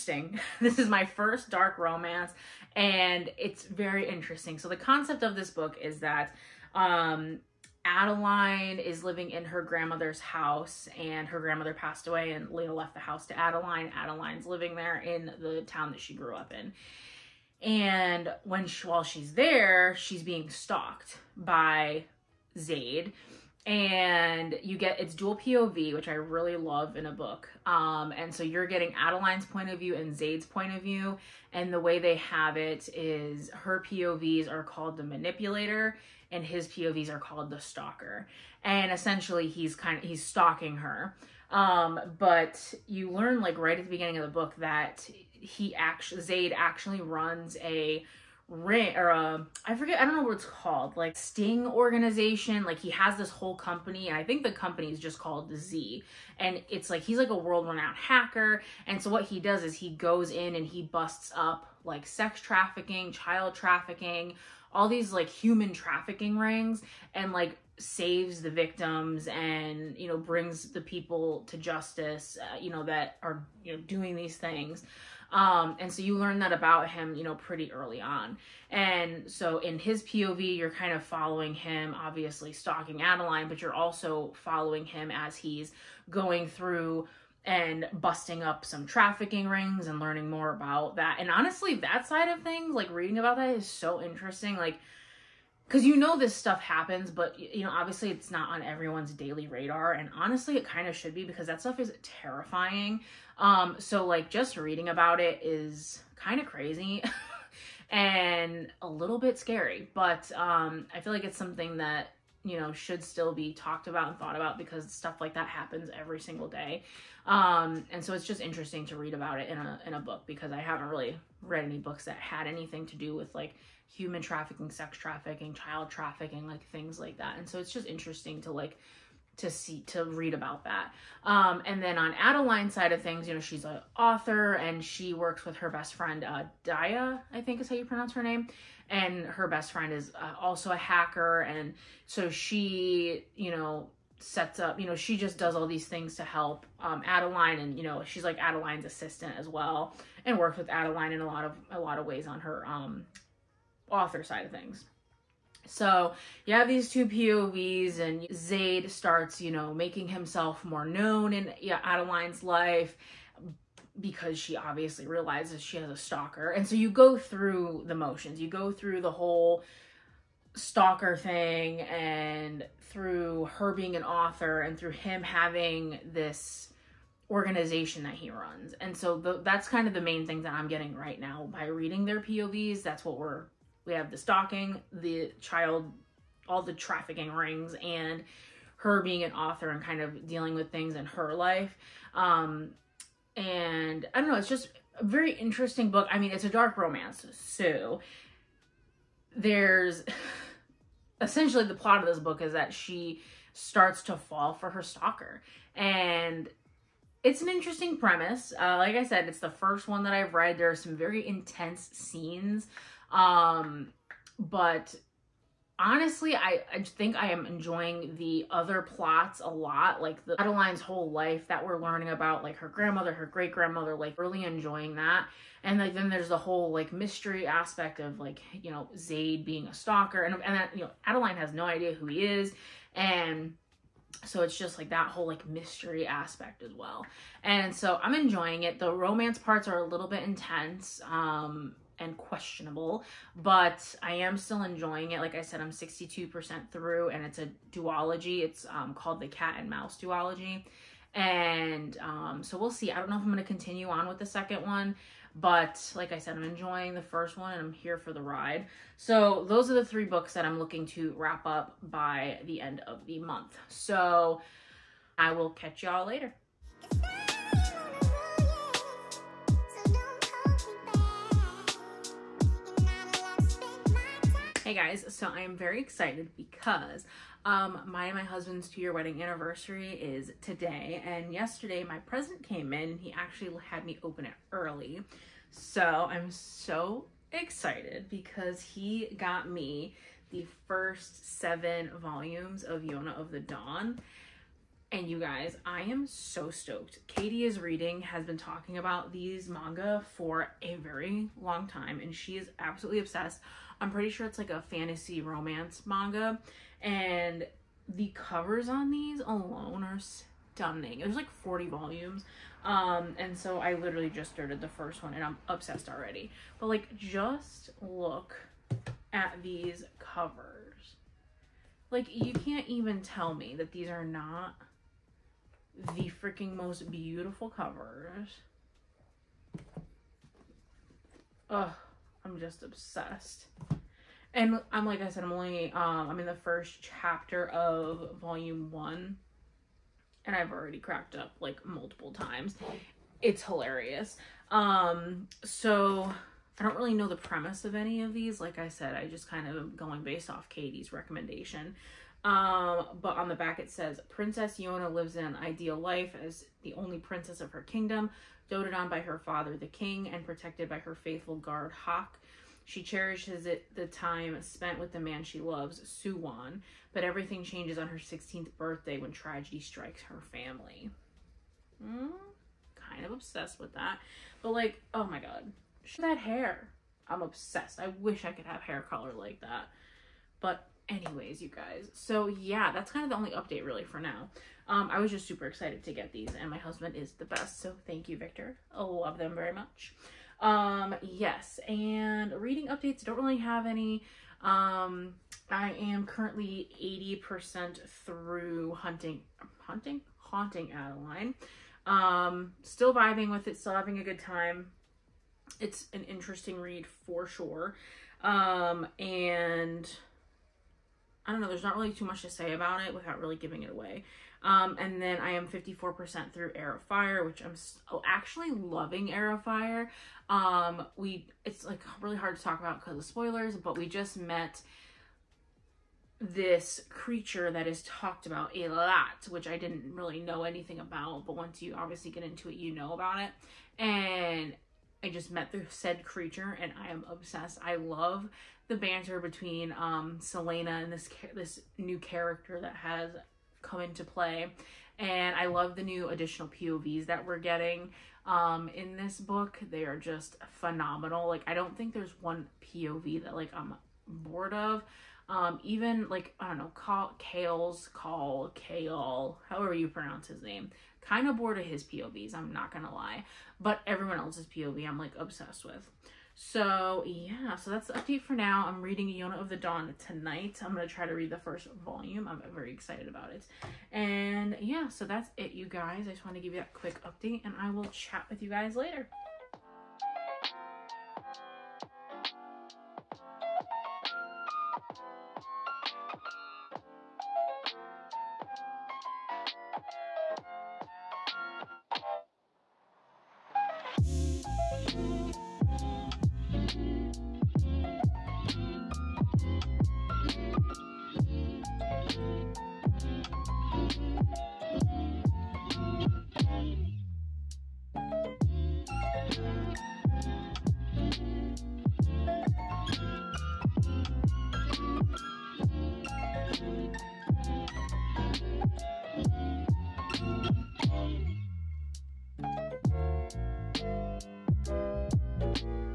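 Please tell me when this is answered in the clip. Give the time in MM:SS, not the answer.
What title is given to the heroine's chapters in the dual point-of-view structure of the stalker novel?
00:34.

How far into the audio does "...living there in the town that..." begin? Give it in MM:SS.
00:14.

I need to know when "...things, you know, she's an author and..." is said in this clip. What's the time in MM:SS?
02:13.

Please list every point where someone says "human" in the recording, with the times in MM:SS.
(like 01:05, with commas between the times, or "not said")
01:05, 02:03.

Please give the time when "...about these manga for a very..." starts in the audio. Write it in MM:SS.
04:58.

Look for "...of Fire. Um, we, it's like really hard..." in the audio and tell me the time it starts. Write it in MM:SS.
06:59.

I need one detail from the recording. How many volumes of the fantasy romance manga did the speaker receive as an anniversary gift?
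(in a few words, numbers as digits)
7.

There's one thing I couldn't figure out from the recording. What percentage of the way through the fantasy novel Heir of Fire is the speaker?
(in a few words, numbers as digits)
54%.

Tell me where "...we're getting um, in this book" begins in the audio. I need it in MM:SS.
07:27.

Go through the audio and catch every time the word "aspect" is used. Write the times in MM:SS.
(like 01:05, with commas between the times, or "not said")
03:47, 03:56.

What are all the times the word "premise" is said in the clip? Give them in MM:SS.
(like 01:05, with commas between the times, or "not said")
03:27, 05:47.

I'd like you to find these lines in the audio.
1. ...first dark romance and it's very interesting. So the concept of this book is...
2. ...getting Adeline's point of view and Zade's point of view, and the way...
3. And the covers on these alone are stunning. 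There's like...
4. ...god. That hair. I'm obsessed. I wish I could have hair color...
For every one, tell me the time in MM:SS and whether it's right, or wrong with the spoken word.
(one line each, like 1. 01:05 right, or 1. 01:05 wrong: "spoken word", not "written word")
1. 00:01 right
2. 00:28 right
3. 05:06 right
4. 06:15 right.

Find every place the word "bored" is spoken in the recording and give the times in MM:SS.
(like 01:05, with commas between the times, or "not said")
07:34, 07:41.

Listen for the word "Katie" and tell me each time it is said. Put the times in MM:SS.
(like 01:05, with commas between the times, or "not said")
04:57, 05:50.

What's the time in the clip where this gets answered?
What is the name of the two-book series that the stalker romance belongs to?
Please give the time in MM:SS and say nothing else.
04:09.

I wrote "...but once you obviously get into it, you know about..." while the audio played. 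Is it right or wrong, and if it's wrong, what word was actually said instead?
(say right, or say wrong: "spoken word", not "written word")
right.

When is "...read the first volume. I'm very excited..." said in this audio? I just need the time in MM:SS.
07:51.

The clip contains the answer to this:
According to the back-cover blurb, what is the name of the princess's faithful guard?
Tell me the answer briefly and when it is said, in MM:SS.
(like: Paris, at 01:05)
Hak, at 06:01.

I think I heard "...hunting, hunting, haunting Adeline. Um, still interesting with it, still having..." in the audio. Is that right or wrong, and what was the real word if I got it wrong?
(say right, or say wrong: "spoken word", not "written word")
wrong: "vibing", not "interesting".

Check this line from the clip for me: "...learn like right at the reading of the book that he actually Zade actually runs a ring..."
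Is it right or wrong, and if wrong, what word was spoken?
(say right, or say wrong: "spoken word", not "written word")
wrong: "beginning", not "reading".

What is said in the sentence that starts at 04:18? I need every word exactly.
So those are the three books that I'm looking to wrap up by the end of the month.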